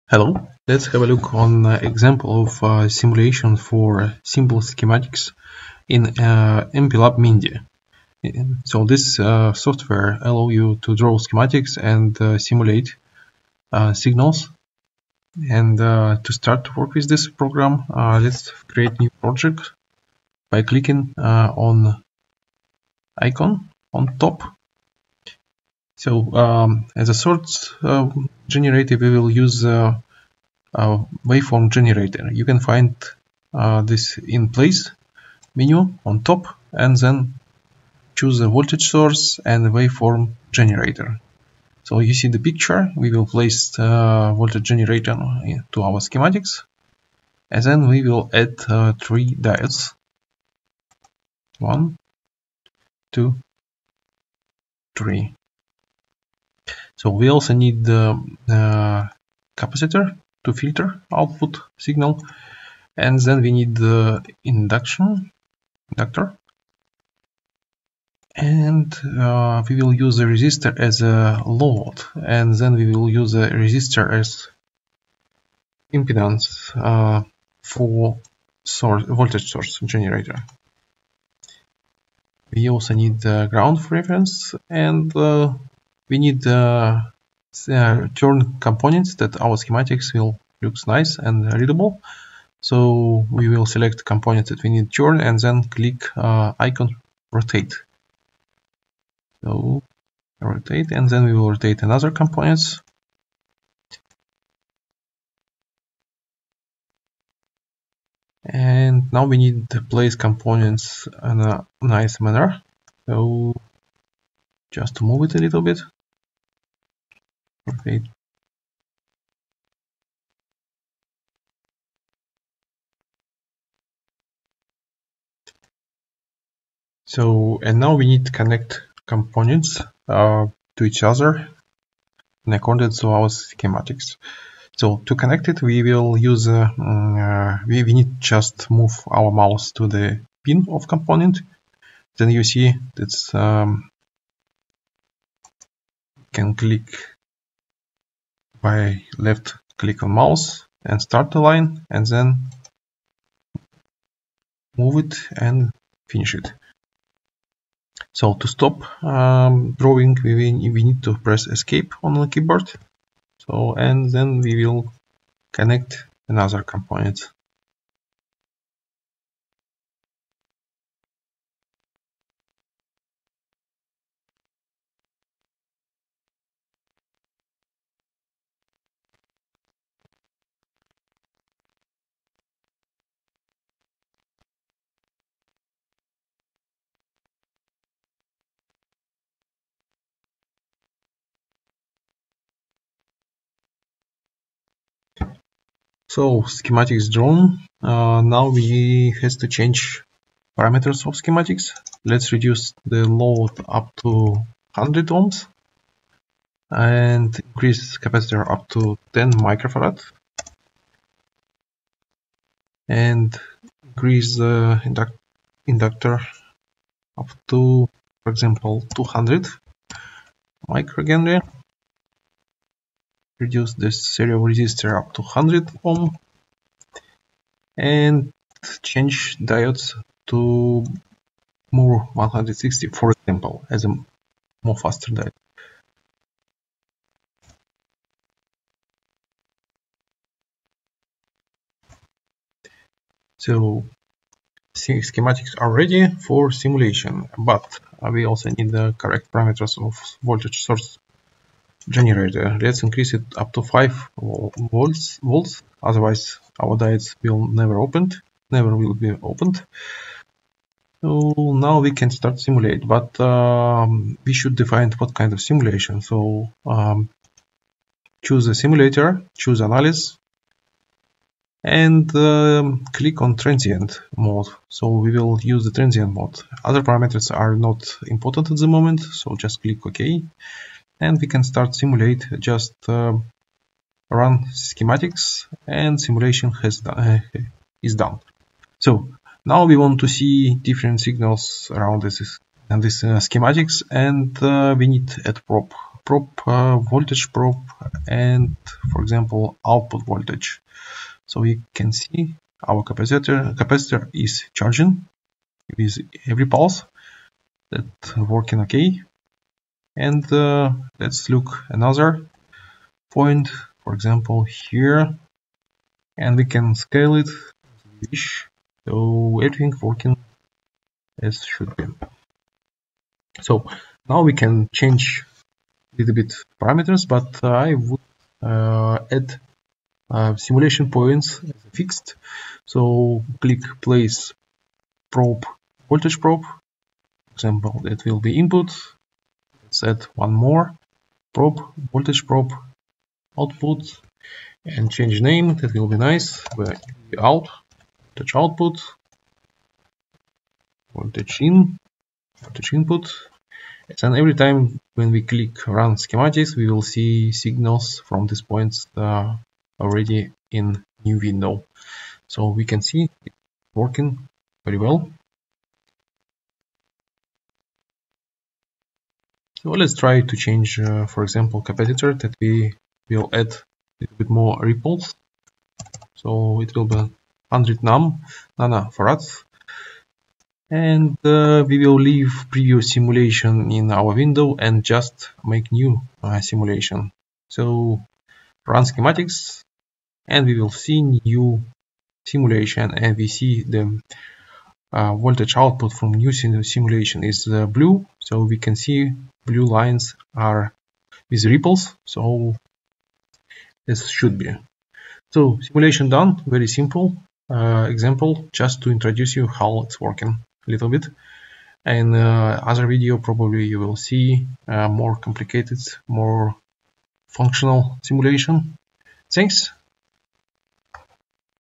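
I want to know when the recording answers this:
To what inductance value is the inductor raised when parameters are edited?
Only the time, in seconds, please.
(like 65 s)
218 s.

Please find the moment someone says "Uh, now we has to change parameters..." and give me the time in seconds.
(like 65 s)
197 s.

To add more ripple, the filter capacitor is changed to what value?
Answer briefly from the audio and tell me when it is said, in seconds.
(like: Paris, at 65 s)
100 nanofarads, at 377 s.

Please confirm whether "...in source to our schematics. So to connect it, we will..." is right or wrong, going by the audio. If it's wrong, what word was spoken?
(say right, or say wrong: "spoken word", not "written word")
wrong: "accordance", not "source".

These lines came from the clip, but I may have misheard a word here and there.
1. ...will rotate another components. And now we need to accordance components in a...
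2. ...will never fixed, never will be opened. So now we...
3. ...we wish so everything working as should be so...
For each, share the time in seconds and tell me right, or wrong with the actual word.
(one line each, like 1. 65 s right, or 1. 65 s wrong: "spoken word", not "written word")
1. 101 s wrong: "place", not "accordance"
2. 257 s wrong: "opened", not "fixed"
3. 318 s right.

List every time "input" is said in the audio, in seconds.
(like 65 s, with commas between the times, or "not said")
338 s, 352 s.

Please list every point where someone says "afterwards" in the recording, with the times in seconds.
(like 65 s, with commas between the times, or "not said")
not said.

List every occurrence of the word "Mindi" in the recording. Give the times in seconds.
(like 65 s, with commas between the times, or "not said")
7 s.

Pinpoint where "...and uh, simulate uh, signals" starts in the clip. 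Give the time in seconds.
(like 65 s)
11 s.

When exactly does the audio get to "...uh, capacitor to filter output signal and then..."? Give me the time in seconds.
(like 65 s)
58 s.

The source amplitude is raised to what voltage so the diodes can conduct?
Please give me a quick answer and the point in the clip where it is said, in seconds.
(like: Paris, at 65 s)
5 volts, at 253 s.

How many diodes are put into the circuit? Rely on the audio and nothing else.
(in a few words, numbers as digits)
3.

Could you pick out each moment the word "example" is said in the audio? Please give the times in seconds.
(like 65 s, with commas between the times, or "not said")
1 s, 218 s, 233 s, 299 s, 313 s, 337 s, 371 s, 407 s.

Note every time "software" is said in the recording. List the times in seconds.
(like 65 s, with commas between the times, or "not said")
9 s.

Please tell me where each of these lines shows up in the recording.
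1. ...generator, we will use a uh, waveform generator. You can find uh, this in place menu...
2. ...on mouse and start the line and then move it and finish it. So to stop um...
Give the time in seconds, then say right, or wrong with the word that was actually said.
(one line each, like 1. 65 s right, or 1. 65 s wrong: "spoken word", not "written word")
1. 28 s right
2. 150 s right.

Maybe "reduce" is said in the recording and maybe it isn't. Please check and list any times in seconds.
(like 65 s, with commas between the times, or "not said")
202 s, 223 s.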